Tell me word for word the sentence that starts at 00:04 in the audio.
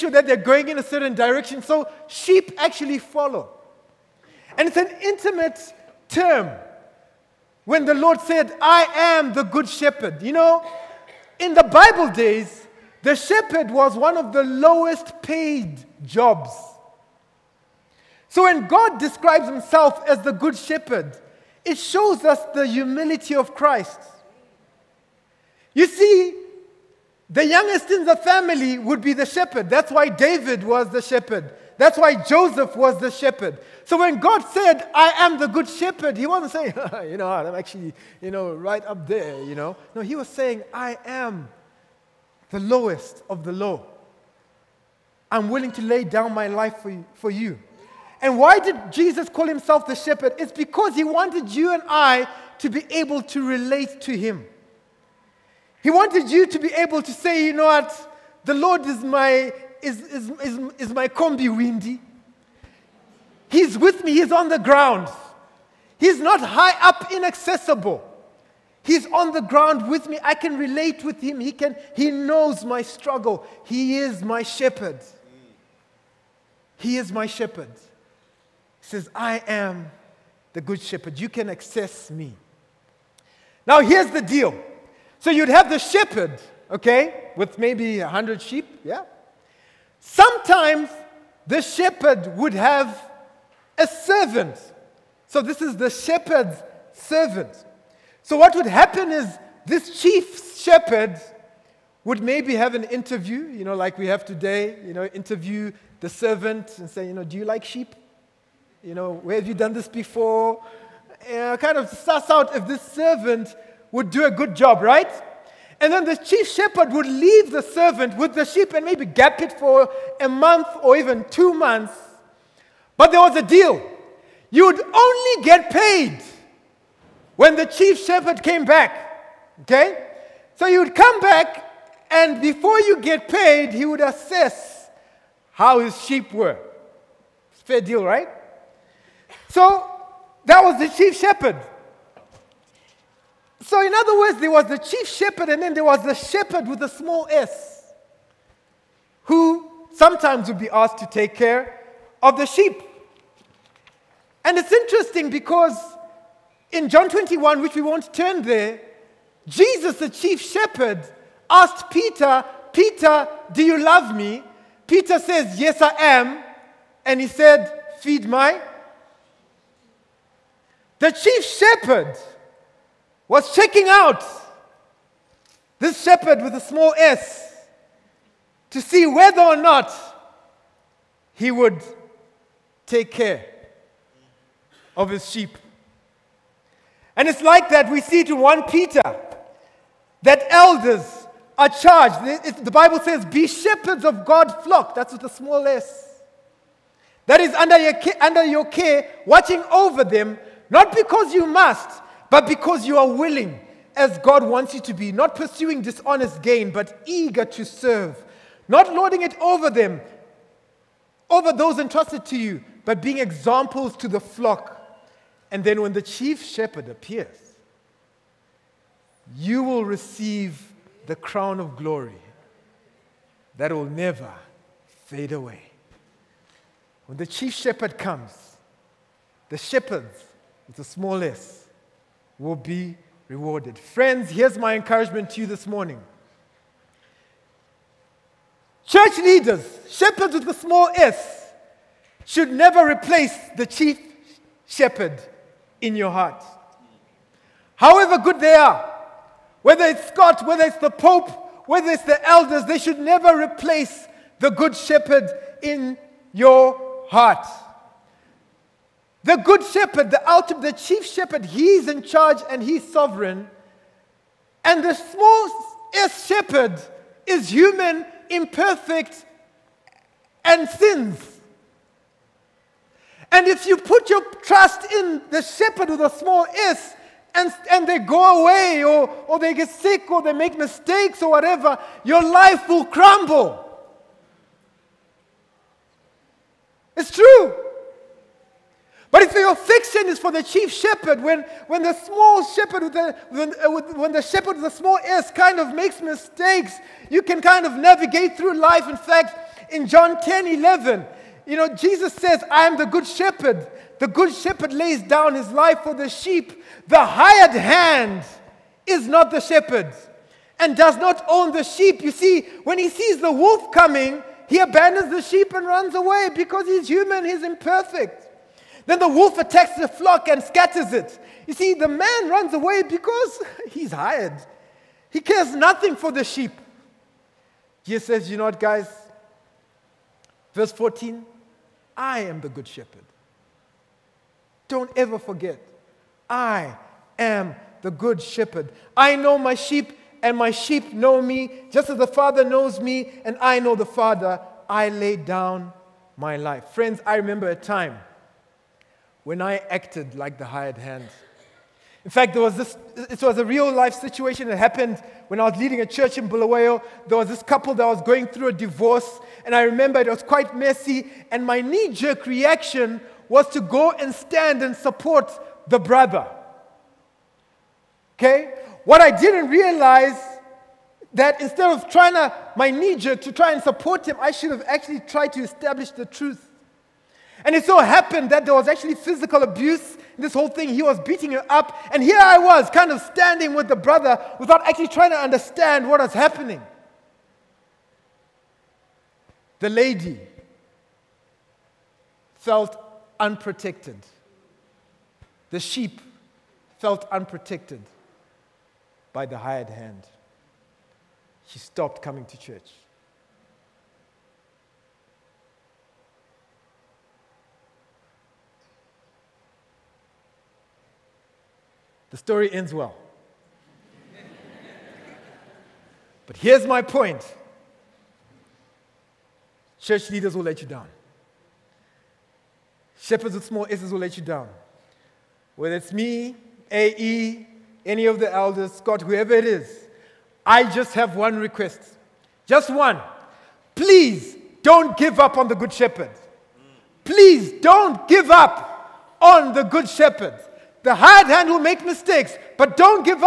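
And it's an intimate term when the Lord said, I am the good shepherd.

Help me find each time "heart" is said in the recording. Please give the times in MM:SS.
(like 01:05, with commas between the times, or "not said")
04:06, 04:17.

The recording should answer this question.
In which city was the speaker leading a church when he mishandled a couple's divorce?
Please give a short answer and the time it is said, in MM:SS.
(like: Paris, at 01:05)
Bulawayo, at 05:56.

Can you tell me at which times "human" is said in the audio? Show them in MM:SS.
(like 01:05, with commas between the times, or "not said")
04:27, 05:16.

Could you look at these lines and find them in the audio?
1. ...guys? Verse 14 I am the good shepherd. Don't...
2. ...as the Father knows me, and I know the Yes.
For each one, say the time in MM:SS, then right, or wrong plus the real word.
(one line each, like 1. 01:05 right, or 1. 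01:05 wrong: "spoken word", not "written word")
1. 05:28 right
2. 05:41 wrong: "Father", not "Yes".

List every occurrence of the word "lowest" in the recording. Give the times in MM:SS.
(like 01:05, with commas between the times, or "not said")
00:14, 00:42.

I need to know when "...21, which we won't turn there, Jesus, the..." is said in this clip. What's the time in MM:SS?
02:37.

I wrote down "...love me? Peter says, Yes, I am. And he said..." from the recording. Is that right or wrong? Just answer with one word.
right.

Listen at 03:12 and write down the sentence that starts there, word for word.
The Bible says, Be shepherds of God's flock.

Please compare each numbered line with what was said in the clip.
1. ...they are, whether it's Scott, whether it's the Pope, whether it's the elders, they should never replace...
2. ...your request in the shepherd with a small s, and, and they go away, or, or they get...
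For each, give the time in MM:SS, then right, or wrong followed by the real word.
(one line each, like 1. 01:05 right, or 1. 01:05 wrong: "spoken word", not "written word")
1. 04:08 right
2. 04:34 wrong: "trust", not "request".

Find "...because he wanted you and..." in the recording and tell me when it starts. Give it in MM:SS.
00:50.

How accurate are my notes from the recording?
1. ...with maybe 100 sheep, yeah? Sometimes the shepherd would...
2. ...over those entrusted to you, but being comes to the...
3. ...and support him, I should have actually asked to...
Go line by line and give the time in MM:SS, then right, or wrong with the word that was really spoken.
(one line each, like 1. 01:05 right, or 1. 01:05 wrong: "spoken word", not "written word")
1. 01:27 right
2. 03:31 wrong: "examples", not "comes"
3. 06:13 wrong: "tried", not "asked".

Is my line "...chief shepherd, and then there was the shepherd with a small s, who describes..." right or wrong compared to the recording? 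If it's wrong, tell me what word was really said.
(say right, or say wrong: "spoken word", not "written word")
wrong: "sometimes", not "describes".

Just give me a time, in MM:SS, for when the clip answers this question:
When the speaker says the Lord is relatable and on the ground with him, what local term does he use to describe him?
01:01.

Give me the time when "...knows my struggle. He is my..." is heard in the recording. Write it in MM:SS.
01:12.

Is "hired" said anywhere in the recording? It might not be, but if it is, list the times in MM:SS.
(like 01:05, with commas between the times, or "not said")
05:07, 05:23, 05:50, 06:39, 07:20.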